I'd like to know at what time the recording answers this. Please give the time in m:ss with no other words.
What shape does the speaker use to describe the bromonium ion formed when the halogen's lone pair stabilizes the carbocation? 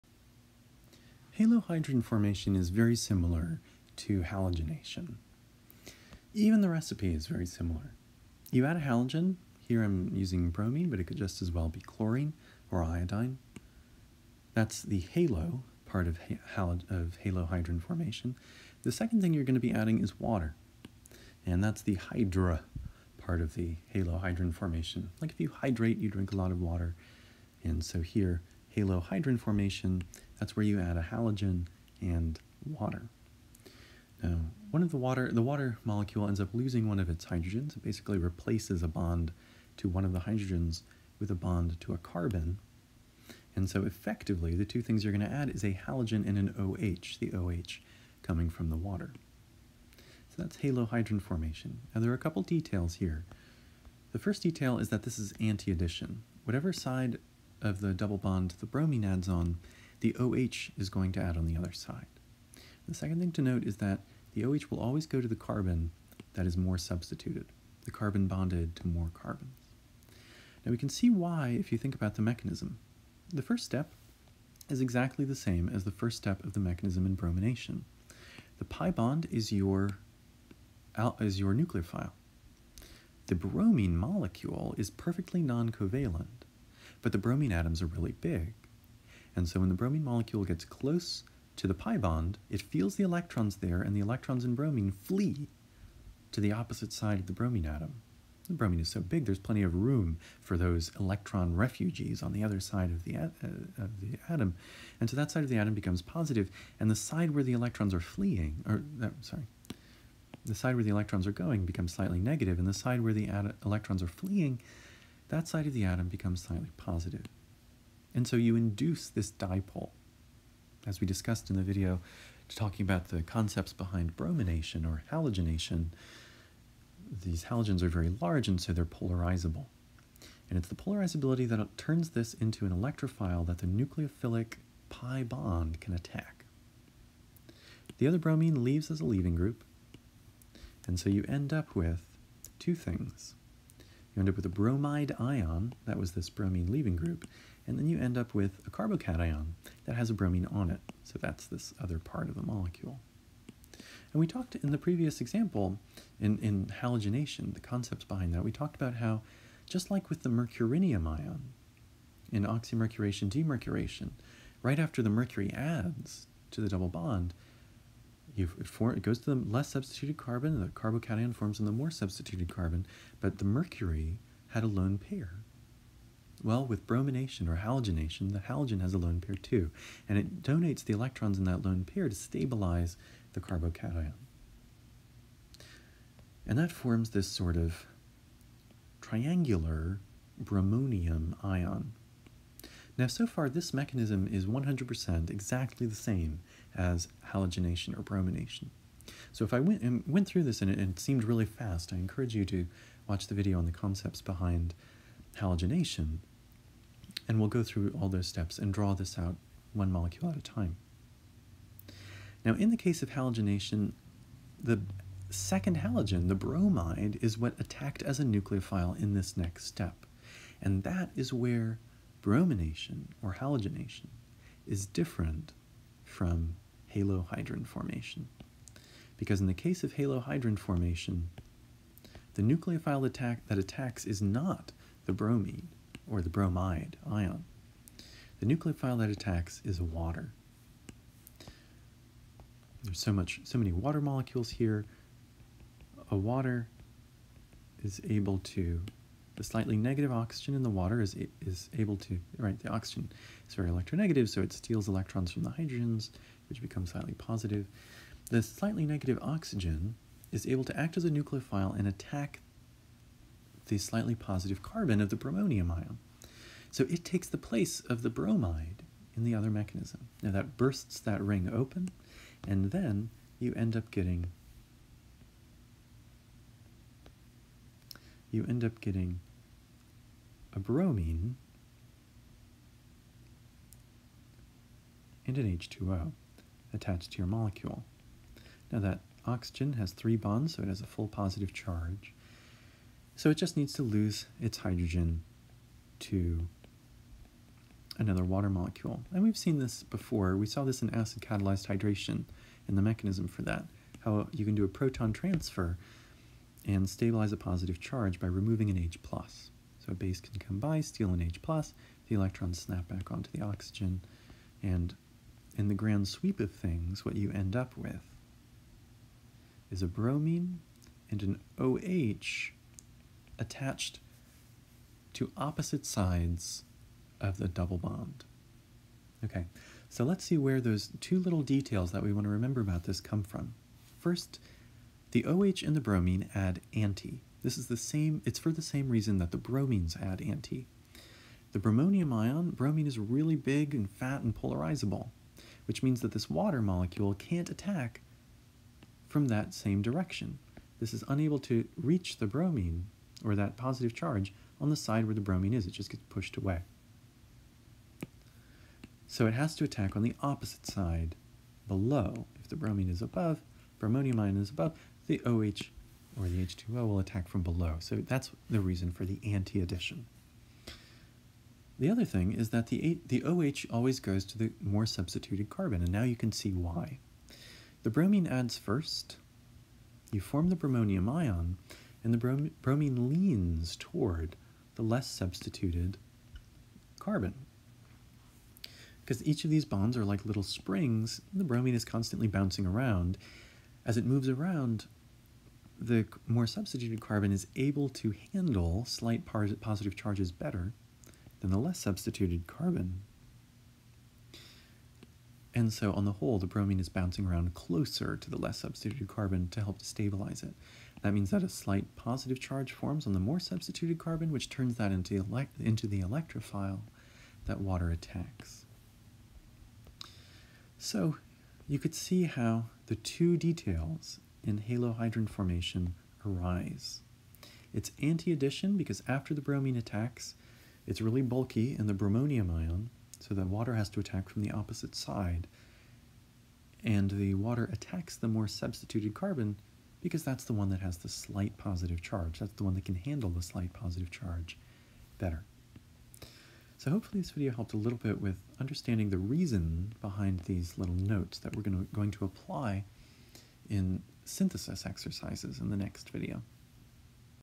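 3:09.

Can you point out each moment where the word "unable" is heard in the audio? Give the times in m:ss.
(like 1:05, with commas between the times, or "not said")
5:51.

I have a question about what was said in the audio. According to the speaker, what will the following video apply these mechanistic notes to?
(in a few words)
synthesis exercises.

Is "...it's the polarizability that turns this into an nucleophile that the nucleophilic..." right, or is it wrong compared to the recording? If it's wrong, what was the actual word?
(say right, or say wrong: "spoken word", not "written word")
wrong: "electrophile", not "nucleophile".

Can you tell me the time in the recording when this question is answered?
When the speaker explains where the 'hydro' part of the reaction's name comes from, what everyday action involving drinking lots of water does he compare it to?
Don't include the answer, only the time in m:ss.
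0:25.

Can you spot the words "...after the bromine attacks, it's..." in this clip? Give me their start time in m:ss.
7:09.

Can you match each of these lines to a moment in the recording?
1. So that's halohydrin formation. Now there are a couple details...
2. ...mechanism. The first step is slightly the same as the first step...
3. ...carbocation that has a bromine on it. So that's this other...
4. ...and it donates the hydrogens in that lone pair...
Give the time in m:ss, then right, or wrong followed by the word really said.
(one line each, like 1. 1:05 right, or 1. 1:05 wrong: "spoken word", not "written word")
1. 0:50 right
2. 1:12 wrong: "exactly", not "slightly"
3. 2:28 right
4. 3:00 wrong: "electrons", not "hydrogens".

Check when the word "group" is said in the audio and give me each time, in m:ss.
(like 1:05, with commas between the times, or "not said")
2:19, 2:26.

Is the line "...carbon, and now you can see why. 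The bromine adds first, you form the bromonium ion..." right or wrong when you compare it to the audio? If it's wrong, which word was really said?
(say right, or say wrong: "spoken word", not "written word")
right.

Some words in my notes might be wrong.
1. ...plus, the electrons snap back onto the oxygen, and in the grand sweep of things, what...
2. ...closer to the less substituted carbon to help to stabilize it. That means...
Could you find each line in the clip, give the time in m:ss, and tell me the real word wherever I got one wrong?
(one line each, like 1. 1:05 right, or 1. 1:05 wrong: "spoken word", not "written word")
1. 5:11 right
2. 6:47 right.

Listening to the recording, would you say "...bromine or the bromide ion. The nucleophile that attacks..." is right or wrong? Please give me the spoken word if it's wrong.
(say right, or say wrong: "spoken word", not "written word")
right.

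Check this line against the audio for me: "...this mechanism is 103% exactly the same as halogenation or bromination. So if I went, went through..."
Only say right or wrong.
wrong.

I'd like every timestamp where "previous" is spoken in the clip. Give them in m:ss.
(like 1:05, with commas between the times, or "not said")
2:34.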